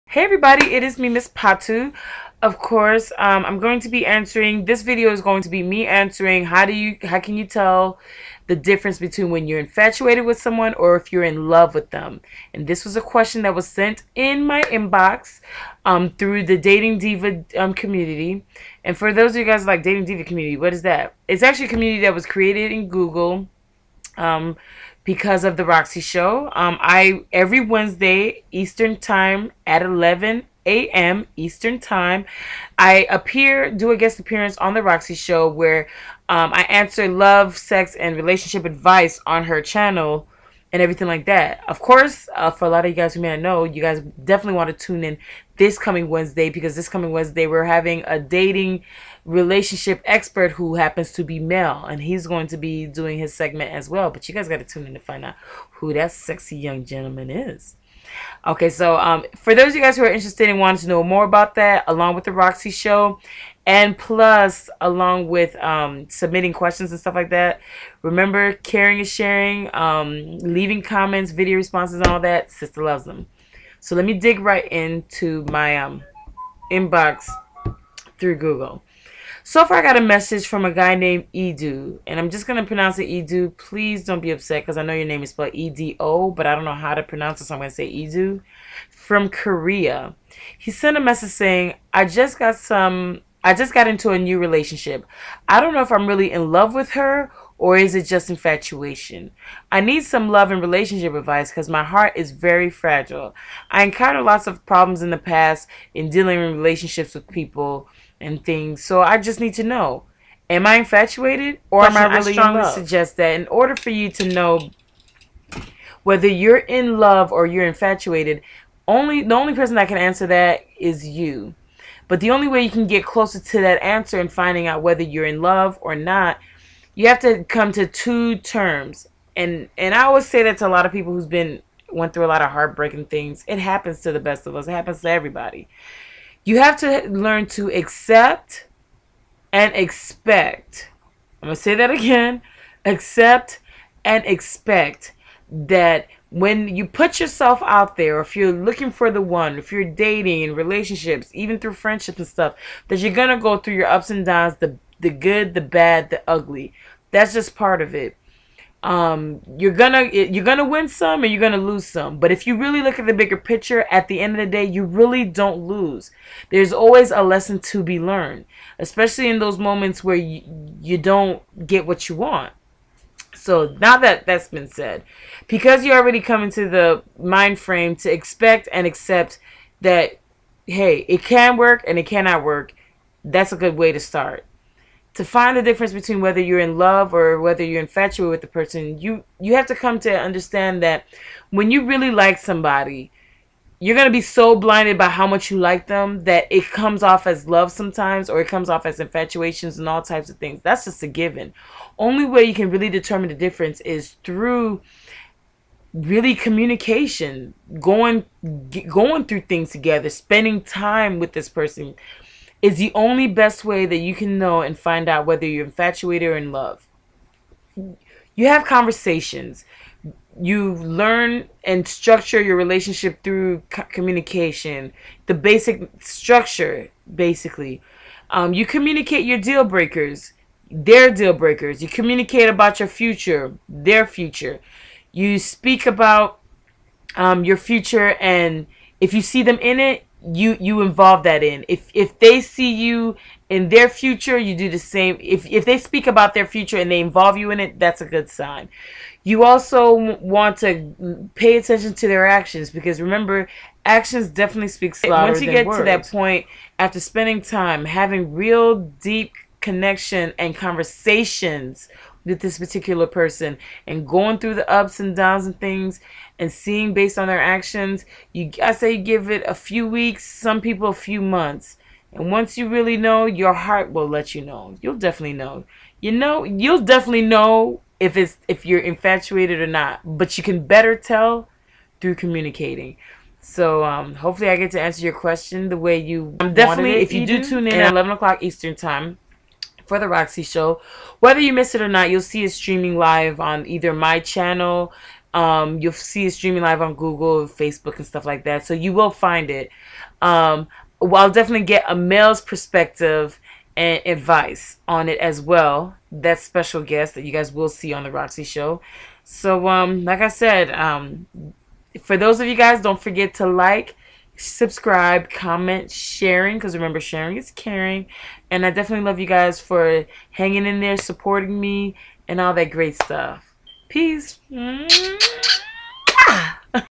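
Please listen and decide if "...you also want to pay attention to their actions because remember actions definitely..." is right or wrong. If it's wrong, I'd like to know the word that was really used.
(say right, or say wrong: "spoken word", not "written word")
right.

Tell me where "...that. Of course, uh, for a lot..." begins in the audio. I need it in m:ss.
0:41.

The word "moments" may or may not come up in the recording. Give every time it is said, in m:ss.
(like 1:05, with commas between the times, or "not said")
2:49.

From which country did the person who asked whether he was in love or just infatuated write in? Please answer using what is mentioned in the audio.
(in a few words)
Korea.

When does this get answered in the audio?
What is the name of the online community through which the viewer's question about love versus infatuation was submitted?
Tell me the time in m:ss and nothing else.
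0:16.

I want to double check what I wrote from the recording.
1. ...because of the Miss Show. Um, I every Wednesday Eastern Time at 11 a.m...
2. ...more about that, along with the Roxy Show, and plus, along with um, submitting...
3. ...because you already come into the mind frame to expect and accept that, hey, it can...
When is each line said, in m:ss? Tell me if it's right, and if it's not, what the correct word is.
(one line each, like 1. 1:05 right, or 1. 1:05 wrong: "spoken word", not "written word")
1. 0:25 wrong: "Roxy", not "Miss"
2. 1:01 right
3. 2:55 right.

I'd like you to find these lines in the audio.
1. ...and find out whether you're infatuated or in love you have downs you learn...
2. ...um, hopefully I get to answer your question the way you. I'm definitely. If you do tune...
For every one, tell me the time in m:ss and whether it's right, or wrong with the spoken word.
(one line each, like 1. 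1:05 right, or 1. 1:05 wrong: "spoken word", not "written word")
1. 3:34 wrong: "conversations", not "downs"
2. 4:43 right.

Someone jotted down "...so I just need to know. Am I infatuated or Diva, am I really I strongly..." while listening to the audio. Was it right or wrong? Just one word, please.
wrong.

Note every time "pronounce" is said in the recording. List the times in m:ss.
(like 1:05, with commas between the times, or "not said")
1:22, 1:27.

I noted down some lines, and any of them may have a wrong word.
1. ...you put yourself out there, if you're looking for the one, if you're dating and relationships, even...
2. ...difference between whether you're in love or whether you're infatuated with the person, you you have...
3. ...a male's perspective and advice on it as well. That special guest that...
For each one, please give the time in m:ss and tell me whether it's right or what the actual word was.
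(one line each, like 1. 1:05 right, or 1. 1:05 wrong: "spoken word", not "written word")
1. 2:26 right
2. 3:05 right
3. 5:01 right.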